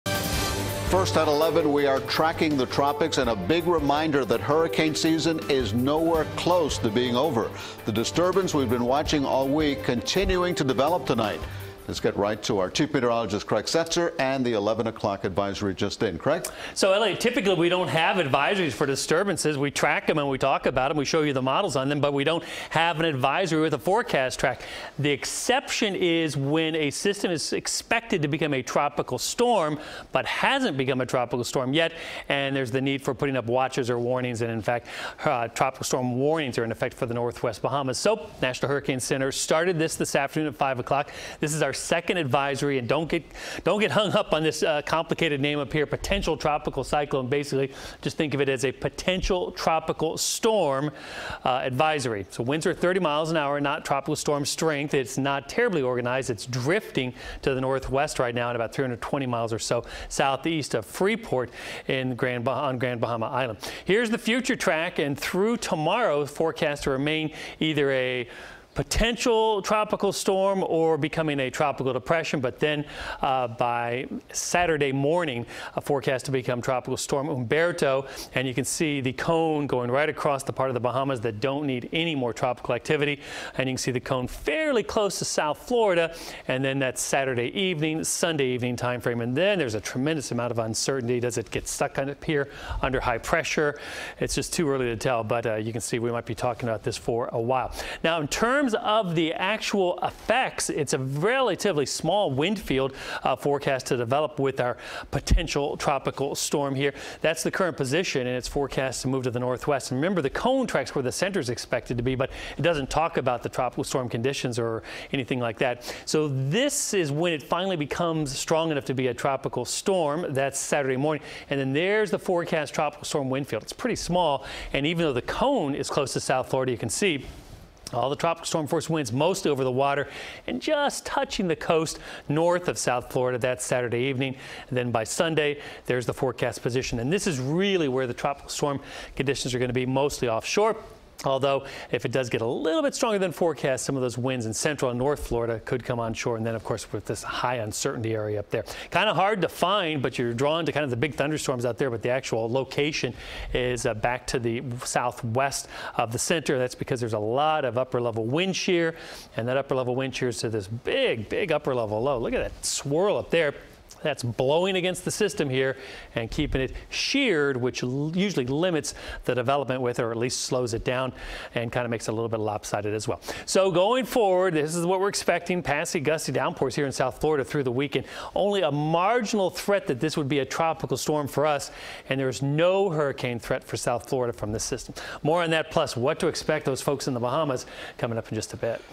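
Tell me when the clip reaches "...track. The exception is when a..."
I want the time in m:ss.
0:24.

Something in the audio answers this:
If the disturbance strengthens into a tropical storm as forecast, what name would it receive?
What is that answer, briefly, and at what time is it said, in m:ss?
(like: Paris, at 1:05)
Umberto, at 1:17.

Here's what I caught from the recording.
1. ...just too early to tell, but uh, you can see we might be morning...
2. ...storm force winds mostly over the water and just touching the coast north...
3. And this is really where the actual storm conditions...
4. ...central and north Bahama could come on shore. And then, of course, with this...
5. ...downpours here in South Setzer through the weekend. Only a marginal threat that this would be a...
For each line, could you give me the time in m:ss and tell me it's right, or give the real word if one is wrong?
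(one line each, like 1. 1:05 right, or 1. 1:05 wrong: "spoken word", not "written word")
1. 1:34 wrong: "talking", not "morning"
2. 2:08 right
3. 2:16 wrong: "tropical", not "actual"
4. 2:24 wrong: "Florida", not "Bahama"
5. 2:56 wrong: "Florida", not "Setzer".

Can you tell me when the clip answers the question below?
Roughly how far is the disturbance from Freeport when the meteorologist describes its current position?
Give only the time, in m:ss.
0:58.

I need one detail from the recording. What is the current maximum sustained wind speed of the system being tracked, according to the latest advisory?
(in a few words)
30 mph.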